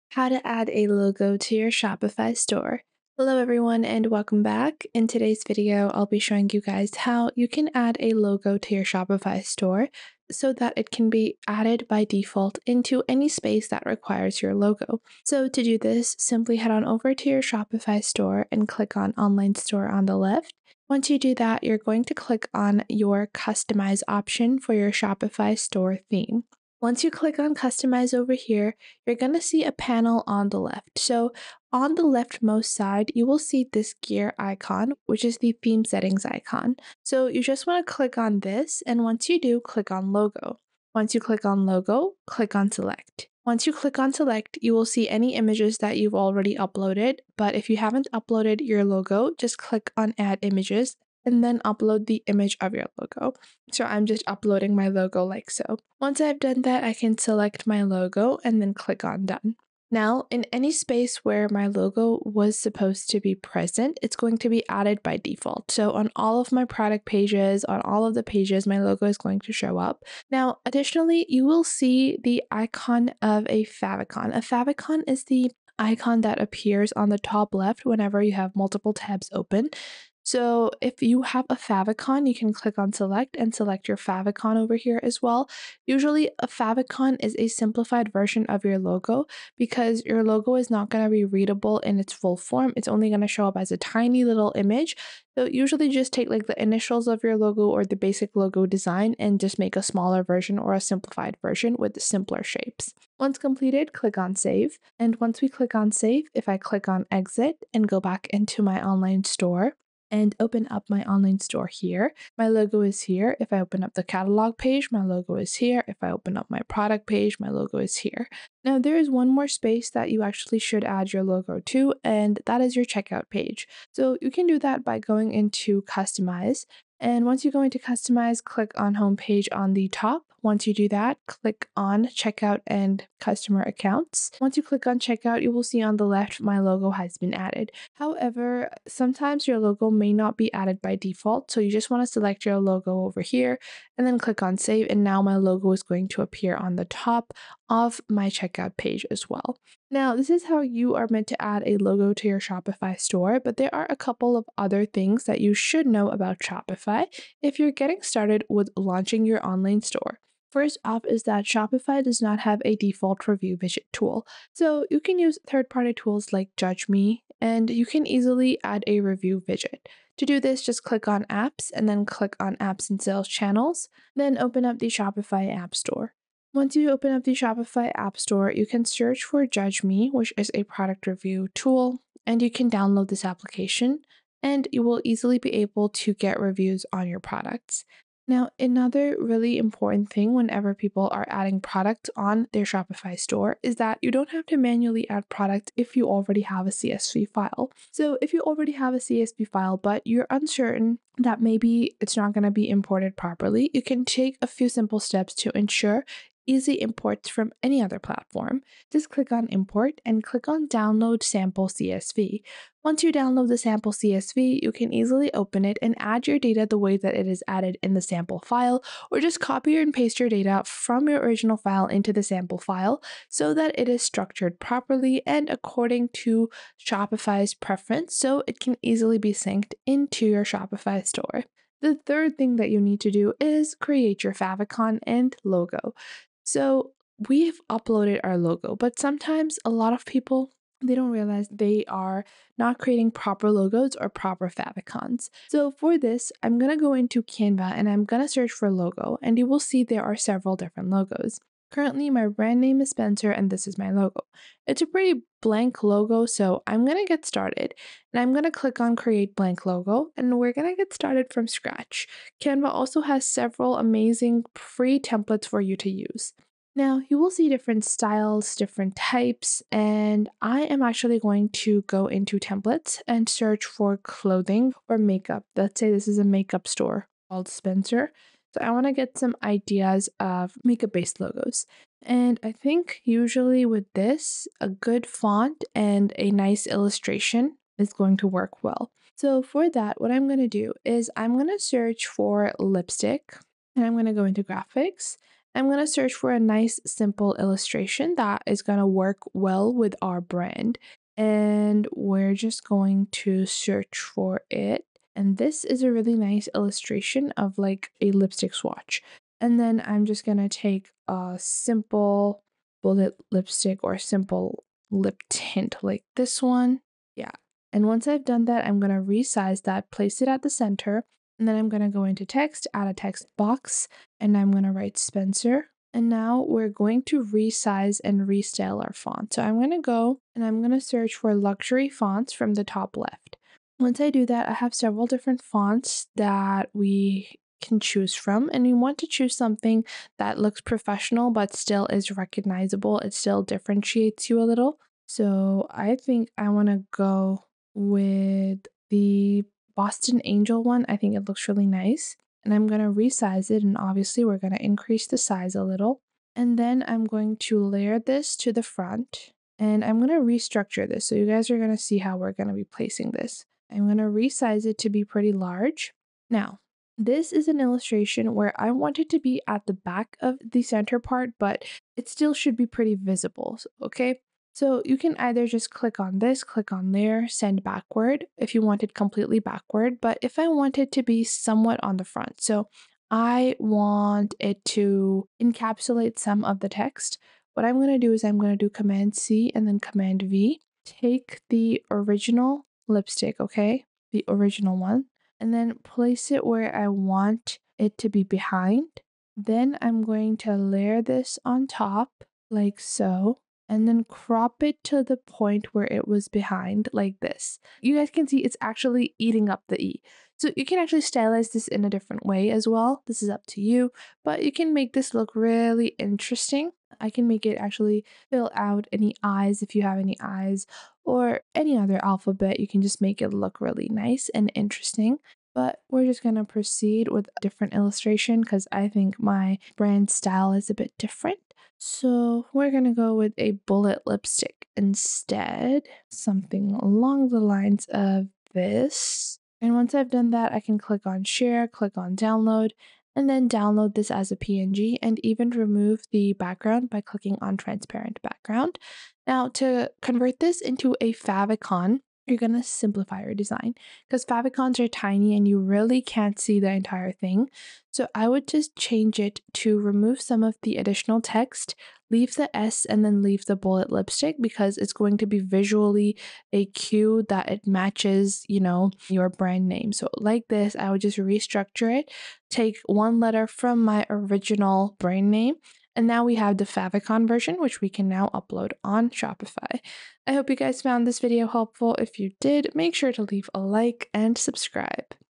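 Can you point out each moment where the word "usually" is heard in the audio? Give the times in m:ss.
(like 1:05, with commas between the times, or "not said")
1:25, 1:35, 4:43.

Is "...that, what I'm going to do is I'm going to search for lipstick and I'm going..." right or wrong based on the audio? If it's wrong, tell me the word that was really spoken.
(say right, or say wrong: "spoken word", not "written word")
right.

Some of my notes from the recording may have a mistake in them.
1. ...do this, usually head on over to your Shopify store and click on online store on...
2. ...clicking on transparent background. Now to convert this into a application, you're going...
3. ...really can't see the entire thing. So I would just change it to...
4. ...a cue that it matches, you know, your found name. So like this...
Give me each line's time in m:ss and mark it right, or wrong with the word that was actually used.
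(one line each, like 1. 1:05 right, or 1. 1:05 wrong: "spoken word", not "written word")
1. 0:15 wrong: "simply", not "usually"
2. 7:27 wrong: "favicon", not "application"
3. 7:35 right
4. 7:46 wrong: "brand", not "found".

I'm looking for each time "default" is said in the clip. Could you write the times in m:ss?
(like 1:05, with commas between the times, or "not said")
0:12, 1:05, 2:20, 2:42.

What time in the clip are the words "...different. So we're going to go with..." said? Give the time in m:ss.
7:10.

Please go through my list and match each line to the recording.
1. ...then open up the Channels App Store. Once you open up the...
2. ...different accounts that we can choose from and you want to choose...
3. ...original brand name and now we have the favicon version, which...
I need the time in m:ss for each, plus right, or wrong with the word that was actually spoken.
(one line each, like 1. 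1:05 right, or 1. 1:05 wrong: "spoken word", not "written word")
1. 2:54 wrong: "Shopify", not "Channels"
2. 5:35 wrong: "fonts", not "accounts"
3. 7:54 right.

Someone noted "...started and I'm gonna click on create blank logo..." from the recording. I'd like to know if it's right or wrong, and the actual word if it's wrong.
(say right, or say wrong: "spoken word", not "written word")
right.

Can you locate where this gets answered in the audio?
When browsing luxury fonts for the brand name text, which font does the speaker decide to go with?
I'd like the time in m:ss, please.
5:49.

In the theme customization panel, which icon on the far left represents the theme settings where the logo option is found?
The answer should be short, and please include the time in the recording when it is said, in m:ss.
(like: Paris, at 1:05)
Gear icon, at 0:34.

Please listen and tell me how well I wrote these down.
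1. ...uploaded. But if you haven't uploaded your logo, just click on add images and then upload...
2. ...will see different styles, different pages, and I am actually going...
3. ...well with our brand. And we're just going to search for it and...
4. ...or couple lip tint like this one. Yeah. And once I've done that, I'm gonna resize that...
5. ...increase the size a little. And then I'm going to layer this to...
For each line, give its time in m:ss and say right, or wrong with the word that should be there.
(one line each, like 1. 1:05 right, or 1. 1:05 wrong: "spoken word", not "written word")
1. 0:46 right
2. 4:27 wrong: "types", not "pages"
3. 4:59 right
4. 5:13 wrong: "simple", not "couple"
5. 5:54 right.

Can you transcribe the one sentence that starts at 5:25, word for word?
And now we're going to resize and restyle our font.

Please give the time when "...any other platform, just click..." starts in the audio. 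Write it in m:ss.
3:27.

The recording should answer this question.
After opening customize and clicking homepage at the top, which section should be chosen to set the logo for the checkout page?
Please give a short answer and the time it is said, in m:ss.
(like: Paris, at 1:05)
Checkout and customer accounts, at 2:12.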